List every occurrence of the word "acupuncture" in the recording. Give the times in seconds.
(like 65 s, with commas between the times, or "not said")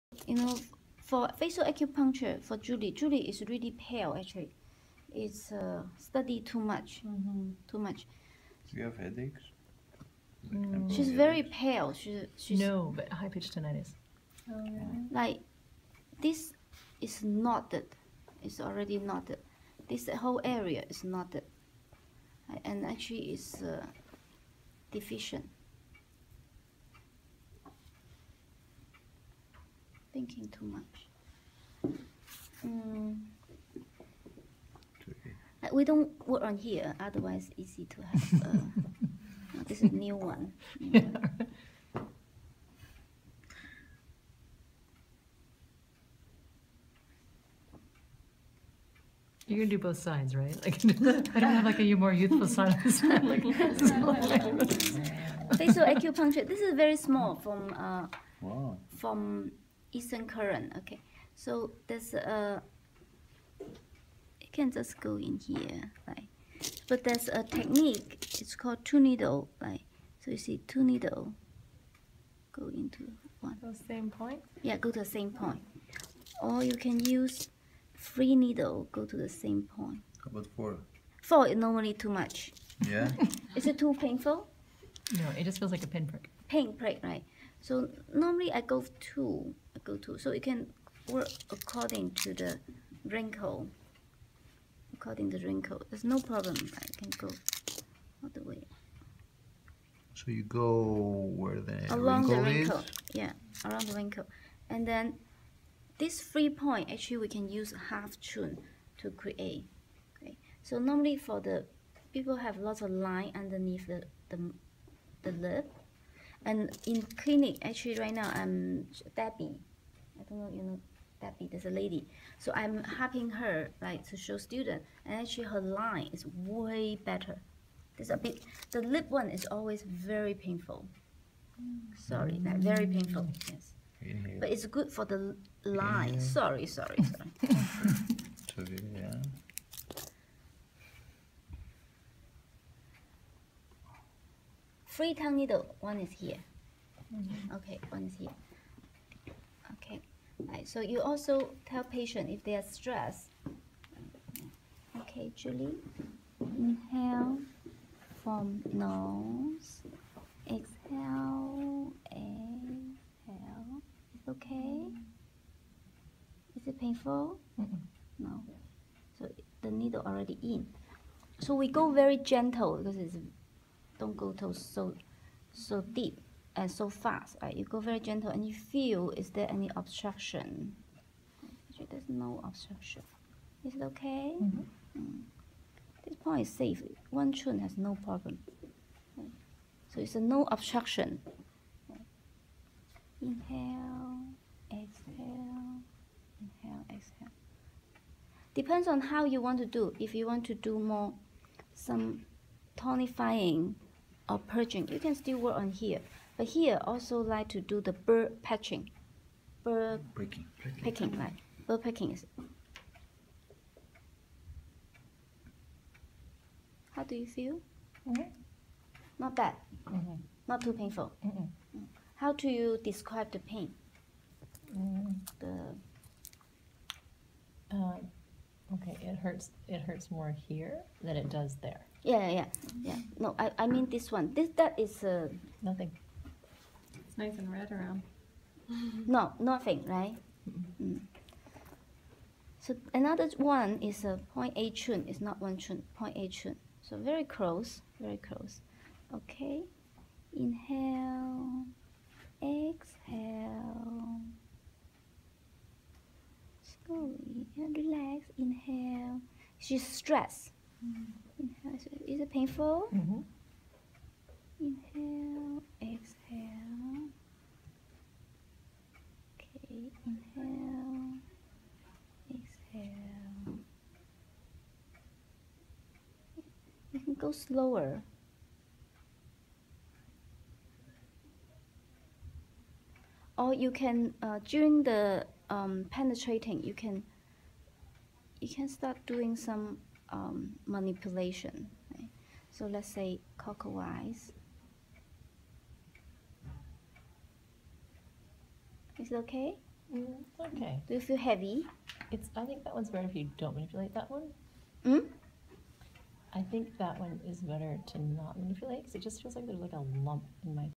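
1 s, 55 s.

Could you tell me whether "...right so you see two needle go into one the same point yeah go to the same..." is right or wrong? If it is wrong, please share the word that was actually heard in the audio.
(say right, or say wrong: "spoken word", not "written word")
right.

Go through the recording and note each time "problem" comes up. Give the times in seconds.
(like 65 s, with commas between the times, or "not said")
96 s, 188 s.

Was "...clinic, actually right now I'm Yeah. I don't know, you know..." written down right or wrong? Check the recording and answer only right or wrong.
wrong.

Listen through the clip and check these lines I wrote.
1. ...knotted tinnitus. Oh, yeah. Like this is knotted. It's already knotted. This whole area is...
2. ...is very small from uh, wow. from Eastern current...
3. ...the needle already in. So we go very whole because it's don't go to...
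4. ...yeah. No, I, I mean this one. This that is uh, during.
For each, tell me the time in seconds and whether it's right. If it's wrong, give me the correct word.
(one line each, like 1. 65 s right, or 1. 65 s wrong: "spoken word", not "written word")
1. 13 s wrong: "pitched", not "knotted"
2. 56 s right
3. 169 s wrong: "gentle", not "whole"
4. 232 s wrong: "nothing", not "during".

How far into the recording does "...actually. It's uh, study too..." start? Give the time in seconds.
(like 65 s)
4 s.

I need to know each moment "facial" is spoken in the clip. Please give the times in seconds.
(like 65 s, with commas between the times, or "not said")
1 s, 55 s.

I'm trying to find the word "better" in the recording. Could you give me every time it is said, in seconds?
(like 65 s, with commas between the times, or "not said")
127 s, 302 s, 307 s.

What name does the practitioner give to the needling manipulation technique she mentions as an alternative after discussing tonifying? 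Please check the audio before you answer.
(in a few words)
bird picking.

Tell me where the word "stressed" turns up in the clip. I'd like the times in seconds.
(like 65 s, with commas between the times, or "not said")
152 s, 259 s.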